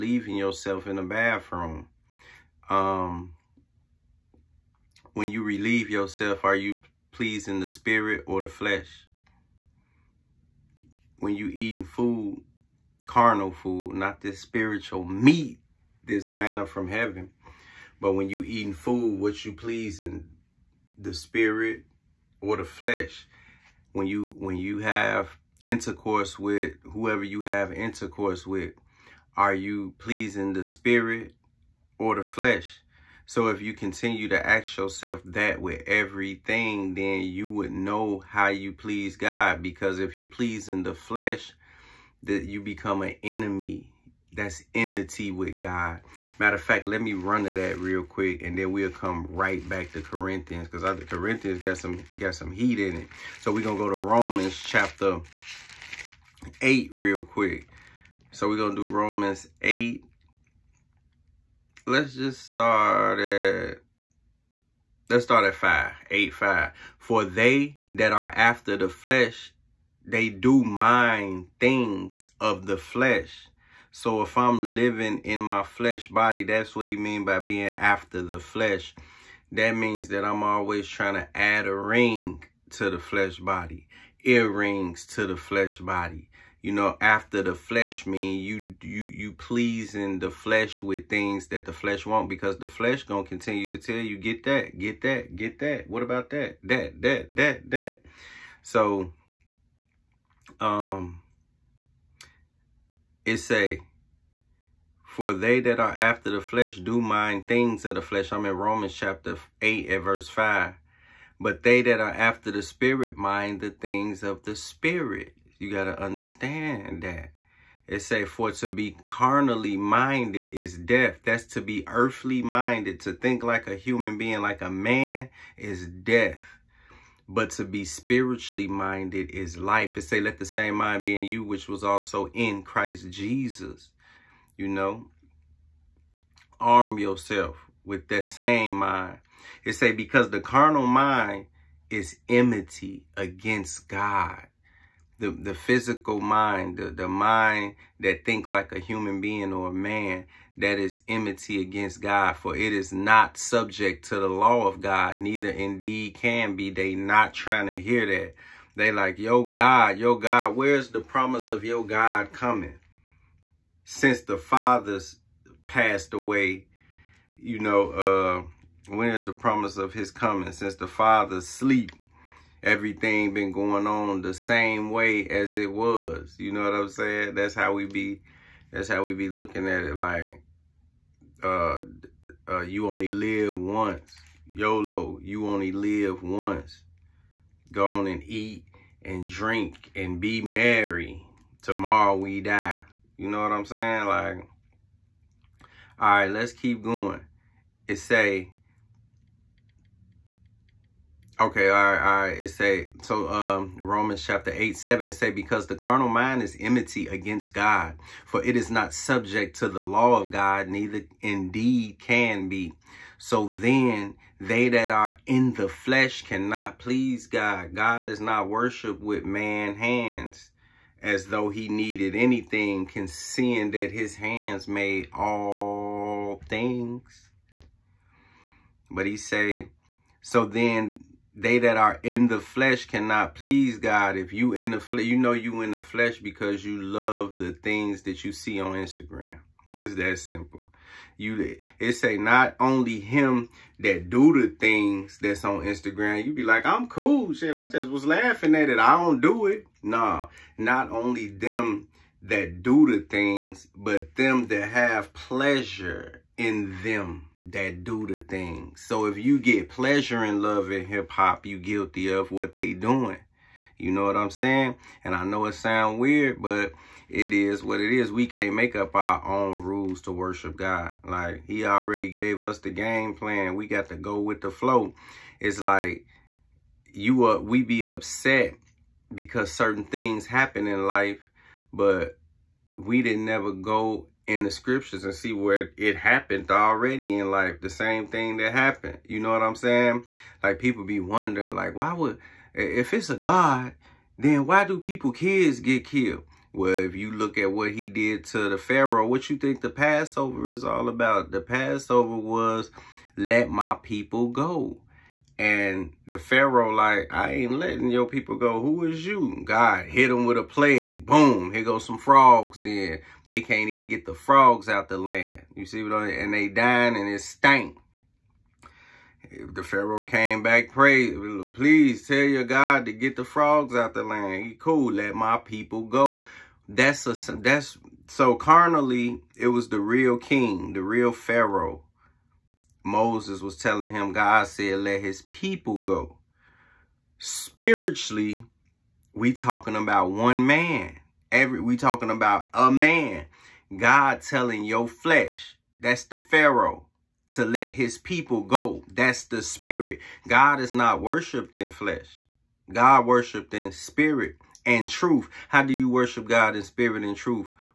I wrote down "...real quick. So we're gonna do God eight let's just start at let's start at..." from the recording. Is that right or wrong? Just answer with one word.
wrong.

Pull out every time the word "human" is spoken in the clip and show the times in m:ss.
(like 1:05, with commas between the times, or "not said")
2:03, 2:28.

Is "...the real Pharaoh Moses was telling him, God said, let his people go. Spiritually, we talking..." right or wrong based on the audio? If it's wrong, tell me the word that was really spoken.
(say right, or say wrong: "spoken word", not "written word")
right.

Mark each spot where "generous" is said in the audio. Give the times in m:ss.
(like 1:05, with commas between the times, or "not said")
not said.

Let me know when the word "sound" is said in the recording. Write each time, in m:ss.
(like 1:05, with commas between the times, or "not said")
4:25.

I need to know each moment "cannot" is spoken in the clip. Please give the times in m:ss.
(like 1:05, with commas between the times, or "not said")
3:36, 3:52.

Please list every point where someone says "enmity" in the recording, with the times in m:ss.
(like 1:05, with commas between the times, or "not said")
0:44, 2:22, 2:31, 3:26.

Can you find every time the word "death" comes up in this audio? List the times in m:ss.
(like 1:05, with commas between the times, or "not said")
2:00, 2:05.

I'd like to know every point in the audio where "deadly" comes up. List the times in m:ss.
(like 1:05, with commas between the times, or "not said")
not said.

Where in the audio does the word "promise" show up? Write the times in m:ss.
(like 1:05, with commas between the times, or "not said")
2:40, 2:49.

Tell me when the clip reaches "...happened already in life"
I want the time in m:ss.
4:45.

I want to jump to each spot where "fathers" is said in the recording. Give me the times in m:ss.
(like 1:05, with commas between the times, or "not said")
2:44, 2:50.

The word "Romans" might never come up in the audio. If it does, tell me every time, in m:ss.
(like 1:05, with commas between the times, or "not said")
0:53, 0:58, 1:48, 3:23.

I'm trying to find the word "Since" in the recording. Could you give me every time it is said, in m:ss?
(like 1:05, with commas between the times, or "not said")
2:43, 2:50.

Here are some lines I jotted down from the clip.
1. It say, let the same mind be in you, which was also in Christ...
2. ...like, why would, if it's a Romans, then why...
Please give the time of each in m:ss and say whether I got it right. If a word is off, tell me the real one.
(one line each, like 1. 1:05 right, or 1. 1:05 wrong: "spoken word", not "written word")
1. 2:09 right
2. 4:51 wrong: "God", not "Romans".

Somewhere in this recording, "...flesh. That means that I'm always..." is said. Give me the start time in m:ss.
1:18.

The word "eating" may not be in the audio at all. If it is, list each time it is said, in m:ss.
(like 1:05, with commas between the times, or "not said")
0:11, 0:18.